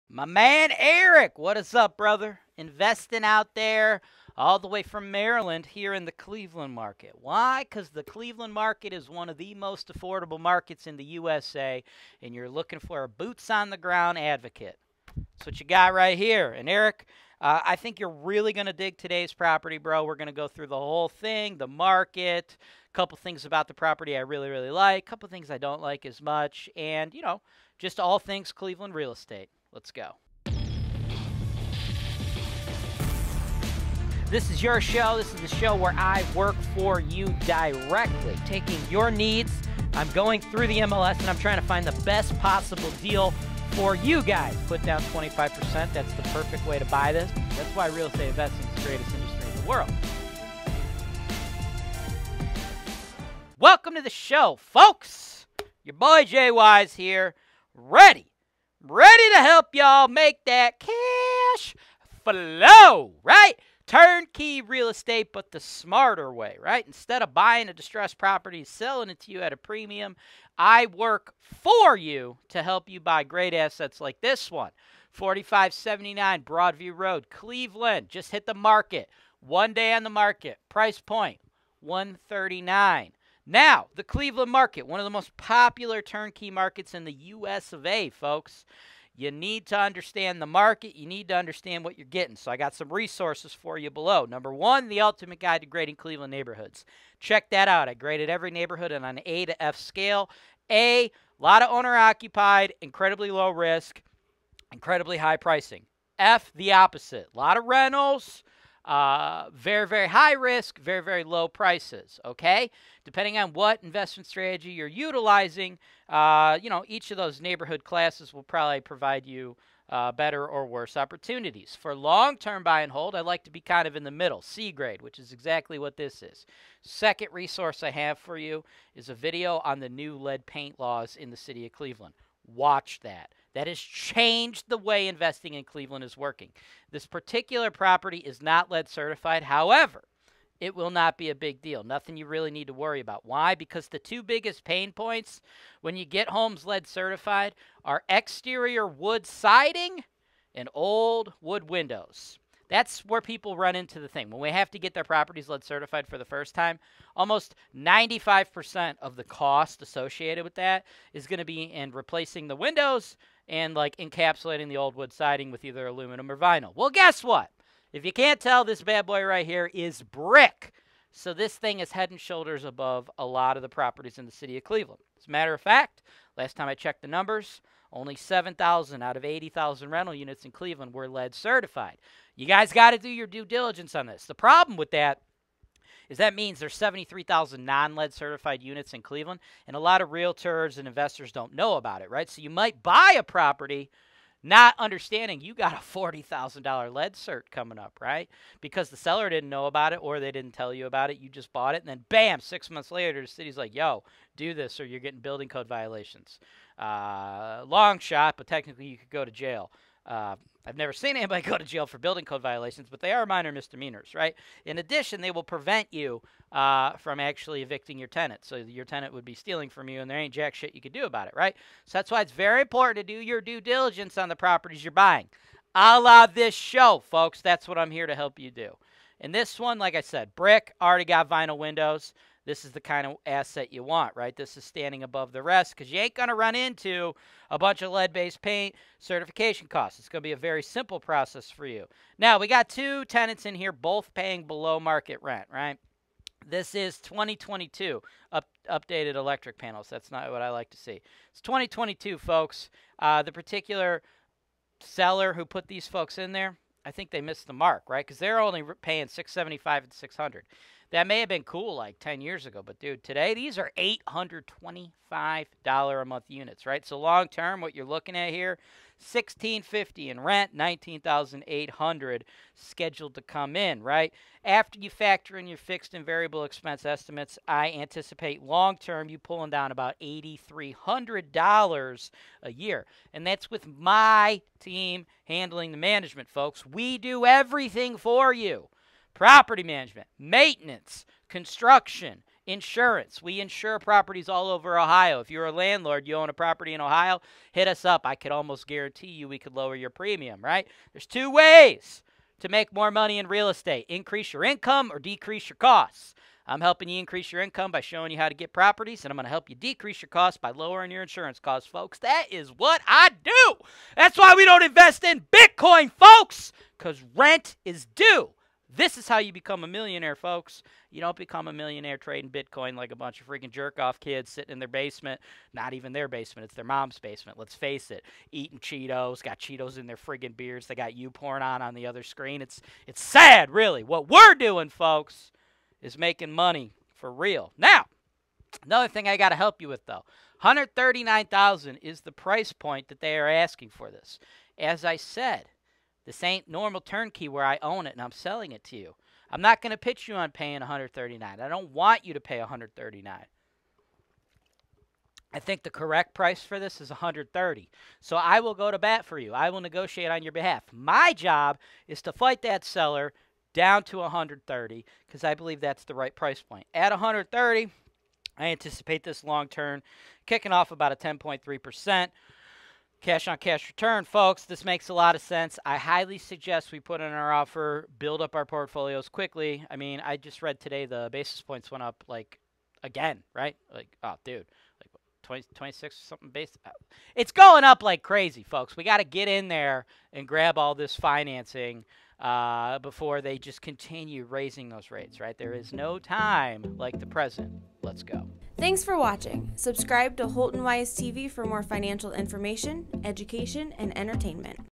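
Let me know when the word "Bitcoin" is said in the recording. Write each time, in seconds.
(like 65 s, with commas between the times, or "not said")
315 s, 322 s.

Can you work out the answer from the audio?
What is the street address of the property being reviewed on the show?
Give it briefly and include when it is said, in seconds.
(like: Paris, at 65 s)
4579 Broadview Road, at 75 s.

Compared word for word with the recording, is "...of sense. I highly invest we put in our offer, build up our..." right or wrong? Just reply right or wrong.
wrong.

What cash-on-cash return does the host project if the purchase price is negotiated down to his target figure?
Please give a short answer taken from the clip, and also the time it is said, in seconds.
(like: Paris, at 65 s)
10.3%, at 370 s.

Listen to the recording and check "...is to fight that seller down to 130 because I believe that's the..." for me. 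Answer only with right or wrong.
right.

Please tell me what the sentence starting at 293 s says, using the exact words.
We insure properties all over Ohio.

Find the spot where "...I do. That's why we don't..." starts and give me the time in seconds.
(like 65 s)
312 s.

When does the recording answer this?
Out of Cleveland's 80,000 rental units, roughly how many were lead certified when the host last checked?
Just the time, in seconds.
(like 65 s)
178 s.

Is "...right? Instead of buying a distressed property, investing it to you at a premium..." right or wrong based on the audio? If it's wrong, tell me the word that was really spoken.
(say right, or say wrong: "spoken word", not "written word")
wrong: "selling", not "investing".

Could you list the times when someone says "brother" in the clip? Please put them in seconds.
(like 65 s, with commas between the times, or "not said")
1 s.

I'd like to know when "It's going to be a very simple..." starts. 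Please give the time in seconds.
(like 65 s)
239 s.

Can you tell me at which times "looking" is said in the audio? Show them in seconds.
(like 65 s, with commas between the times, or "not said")
12 s, 267 s.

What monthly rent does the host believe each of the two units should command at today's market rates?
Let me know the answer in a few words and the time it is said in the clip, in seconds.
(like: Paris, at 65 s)
$825, at 263 s.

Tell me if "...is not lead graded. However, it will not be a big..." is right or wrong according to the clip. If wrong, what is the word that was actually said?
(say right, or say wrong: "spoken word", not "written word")
wrong: "certified", not "graded".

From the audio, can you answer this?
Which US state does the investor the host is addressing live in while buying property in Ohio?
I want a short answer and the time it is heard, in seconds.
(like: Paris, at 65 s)
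Maryland, at 5 s.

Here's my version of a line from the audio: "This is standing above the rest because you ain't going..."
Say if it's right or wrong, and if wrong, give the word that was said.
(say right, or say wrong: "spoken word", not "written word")
right.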